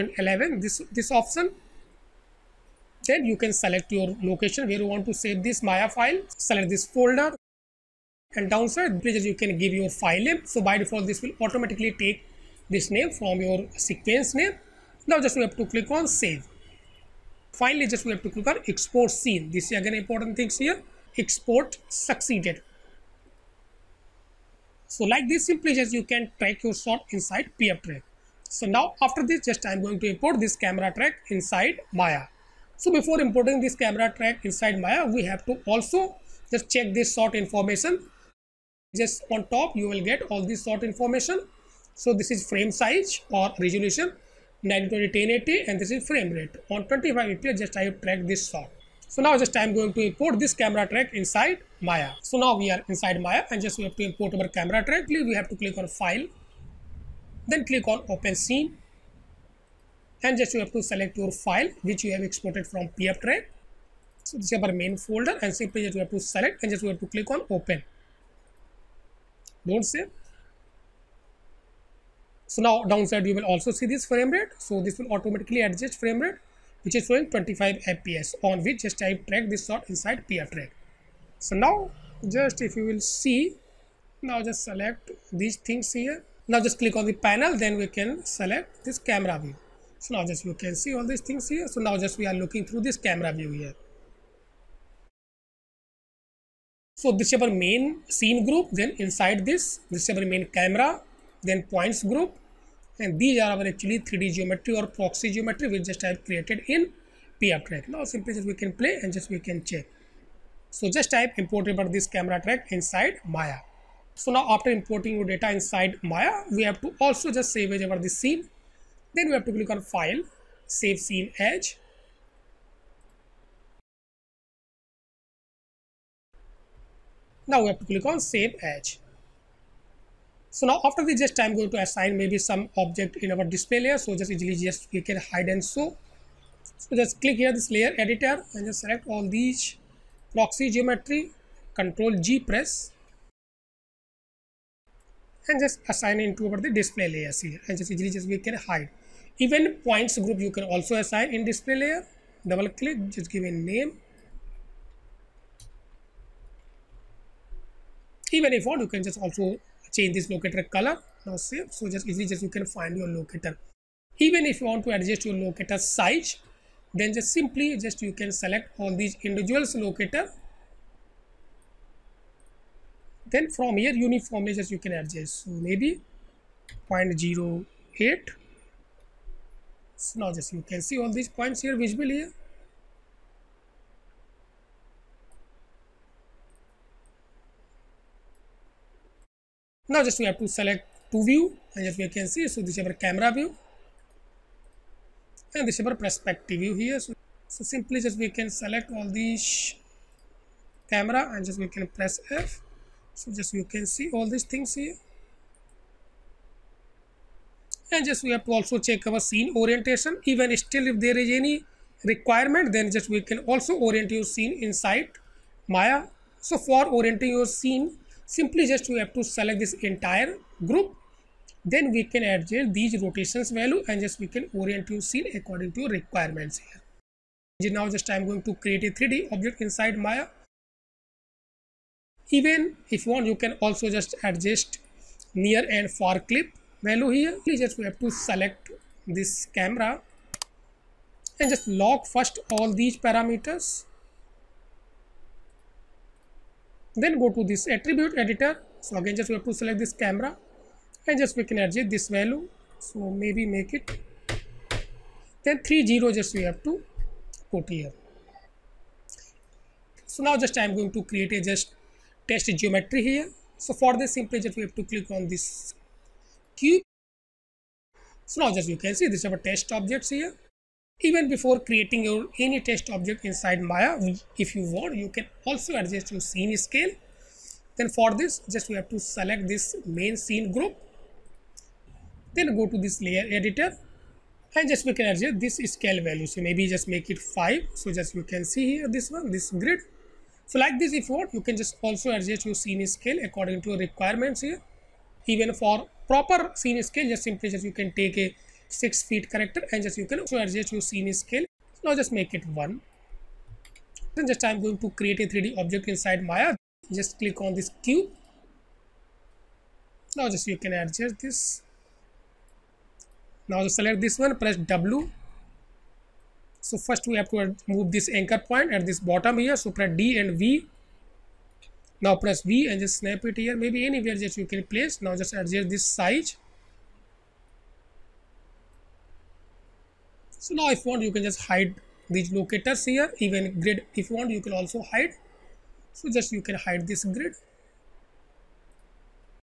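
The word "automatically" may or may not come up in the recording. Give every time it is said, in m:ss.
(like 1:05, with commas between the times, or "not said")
0:11, 1:15.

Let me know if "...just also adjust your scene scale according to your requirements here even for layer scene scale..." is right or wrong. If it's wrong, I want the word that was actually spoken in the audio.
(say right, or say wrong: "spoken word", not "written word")
wrong: "proper", not "layer".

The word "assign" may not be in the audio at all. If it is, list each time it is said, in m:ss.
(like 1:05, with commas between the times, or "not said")
2:11, 2:25, 2:30.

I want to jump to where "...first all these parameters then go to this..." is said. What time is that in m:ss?
4:02.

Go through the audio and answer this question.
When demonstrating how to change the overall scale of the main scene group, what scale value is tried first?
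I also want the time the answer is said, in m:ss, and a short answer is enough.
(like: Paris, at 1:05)
5, at 4:46.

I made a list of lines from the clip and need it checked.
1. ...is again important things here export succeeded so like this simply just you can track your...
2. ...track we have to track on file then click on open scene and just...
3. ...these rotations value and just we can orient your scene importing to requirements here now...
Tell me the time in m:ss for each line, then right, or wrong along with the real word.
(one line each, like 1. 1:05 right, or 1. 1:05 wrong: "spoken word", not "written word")
1. 0:19 right
2. 0:54 wrong: "click", not "track"
3. 3:42 wrong: "according", not "importing".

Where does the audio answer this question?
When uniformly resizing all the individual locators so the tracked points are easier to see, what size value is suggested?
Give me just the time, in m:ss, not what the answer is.
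2:56.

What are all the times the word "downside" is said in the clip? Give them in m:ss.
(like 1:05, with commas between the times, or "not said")
0:08, 1:12.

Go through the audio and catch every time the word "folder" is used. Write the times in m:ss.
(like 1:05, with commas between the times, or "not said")
0:06, 1:04.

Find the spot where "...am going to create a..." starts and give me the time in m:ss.
4:20.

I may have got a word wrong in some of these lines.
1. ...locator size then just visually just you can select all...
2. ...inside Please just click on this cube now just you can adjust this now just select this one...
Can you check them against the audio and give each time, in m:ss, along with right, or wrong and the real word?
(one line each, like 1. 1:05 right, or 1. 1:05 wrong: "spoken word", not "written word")
1. 2:45 wrong: "simply", not "visually"
2. 5:05 wrong: "Maya", not "Please".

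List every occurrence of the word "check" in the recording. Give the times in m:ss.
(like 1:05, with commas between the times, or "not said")
0:36, 1:49, 3:28.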